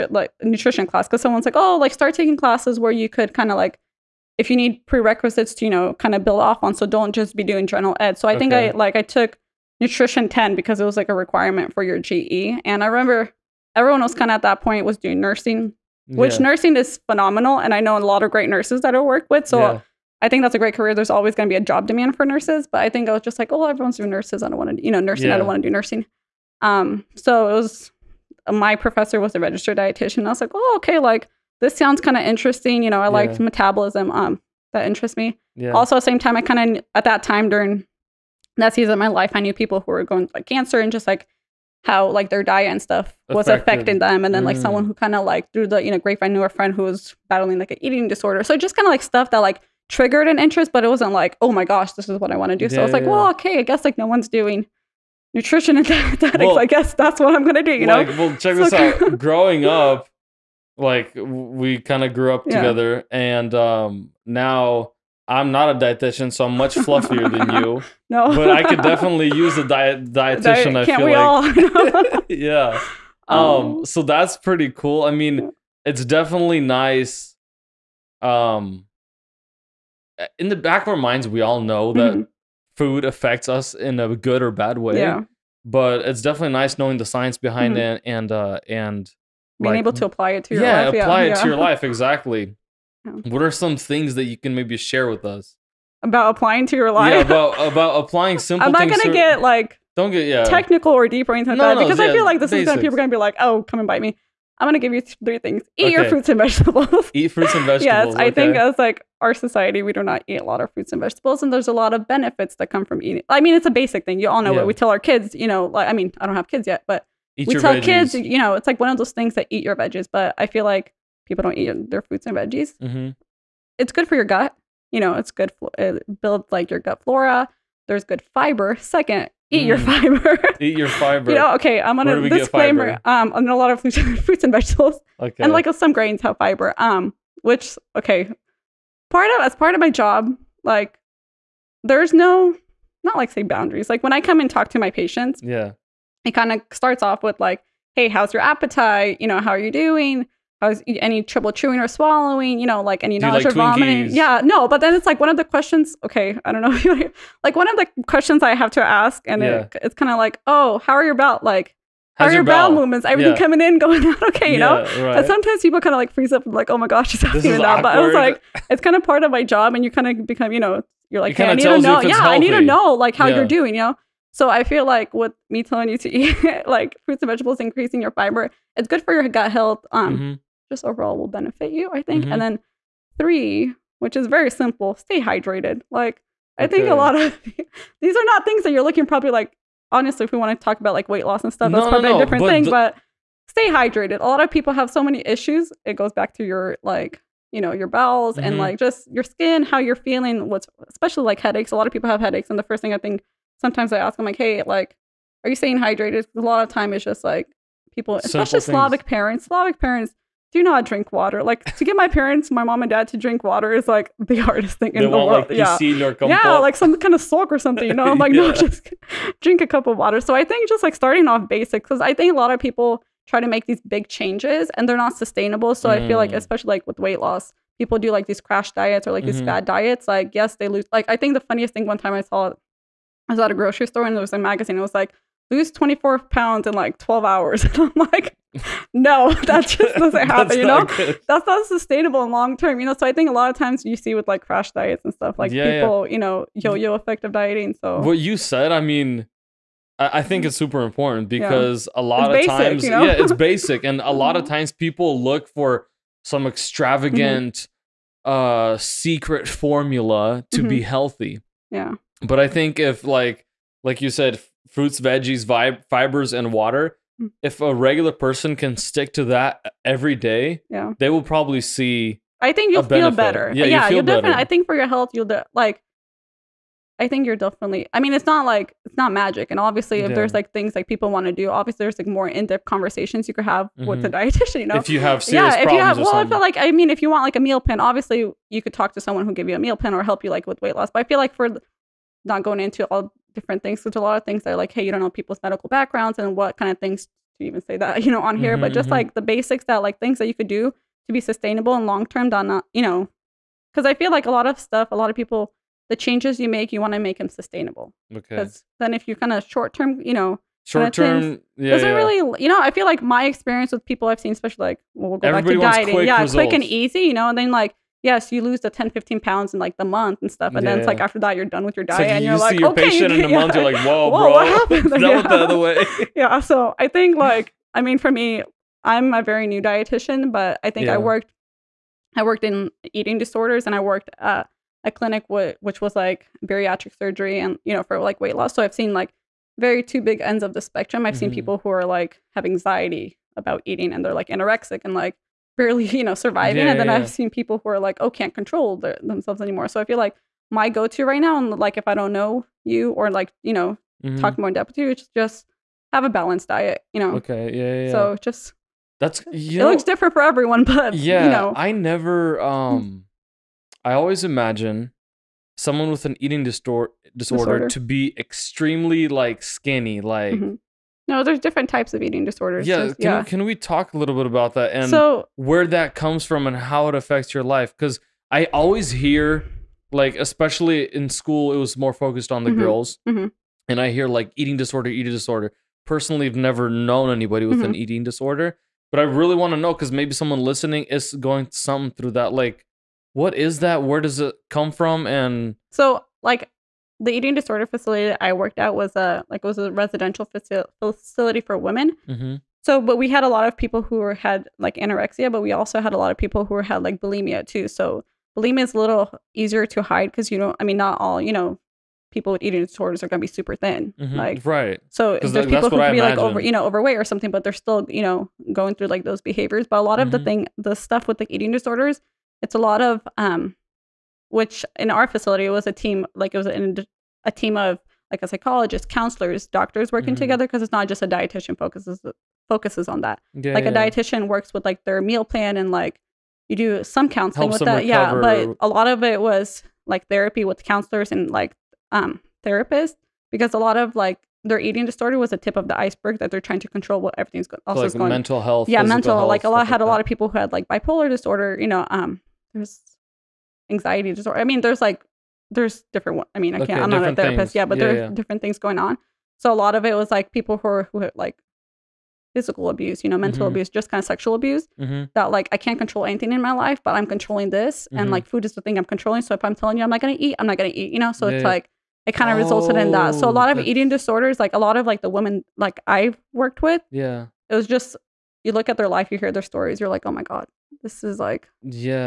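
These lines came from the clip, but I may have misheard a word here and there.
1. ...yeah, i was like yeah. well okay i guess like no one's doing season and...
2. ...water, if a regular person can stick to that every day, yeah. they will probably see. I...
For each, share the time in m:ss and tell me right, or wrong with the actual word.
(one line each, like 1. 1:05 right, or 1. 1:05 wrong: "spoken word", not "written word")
1. 0:52 wrong: "nutrition", not "season"
2. 4:26 right.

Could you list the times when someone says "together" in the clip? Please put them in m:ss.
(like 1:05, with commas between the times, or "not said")
1:02, 7:10.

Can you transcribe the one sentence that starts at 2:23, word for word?
Like when I come and talk to my patients, yeah, it kind of starts off with like, hey, how's your appetite?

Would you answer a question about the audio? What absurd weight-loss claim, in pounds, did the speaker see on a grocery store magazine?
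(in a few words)
24 pounds.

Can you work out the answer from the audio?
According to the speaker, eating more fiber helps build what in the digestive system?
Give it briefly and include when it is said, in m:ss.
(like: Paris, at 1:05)
Gut flora, at 2:06.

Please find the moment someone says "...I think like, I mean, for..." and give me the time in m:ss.
5:26.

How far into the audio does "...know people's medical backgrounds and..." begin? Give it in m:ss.
4:54.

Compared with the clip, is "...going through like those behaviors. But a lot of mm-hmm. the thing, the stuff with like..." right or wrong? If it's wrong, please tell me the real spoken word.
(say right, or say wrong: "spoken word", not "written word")
right.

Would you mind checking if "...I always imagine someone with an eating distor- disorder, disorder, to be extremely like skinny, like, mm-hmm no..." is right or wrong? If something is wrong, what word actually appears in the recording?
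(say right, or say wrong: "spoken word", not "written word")
right.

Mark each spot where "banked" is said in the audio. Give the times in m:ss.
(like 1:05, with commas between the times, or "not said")
not said.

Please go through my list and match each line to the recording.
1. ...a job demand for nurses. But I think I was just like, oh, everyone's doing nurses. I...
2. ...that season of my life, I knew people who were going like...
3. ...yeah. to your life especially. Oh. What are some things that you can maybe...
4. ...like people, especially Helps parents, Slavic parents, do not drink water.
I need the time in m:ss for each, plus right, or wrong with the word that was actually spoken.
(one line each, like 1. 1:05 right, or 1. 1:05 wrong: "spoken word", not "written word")
1. 0:21 right
2. 0:38 right
3. 1:31 wrong: "exactly", not "especially"
4. 3:27 wrong: "Slavic", not "Helps".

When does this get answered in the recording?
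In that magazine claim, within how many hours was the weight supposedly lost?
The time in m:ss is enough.
3:56.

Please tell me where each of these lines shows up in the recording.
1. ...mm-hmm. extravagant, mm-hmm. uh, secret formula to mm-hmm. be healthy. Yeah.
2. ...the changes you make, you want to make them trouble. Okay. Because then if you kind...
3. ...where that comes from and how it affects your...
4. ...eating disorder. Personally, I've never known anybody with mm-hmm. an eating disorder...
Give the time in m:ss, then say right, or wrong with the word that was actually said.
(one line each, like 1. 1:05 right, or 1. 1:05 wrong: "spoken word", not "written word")
1. 4:16 right
2. 5:05 wrong: "sustainable", not "trouble"
3. 6:15 right
4. 6:24 right.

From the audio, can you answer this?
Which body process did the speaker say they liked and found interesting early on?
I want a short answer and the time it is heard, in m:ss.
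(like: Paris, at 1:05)
Metabolism, at 0:33.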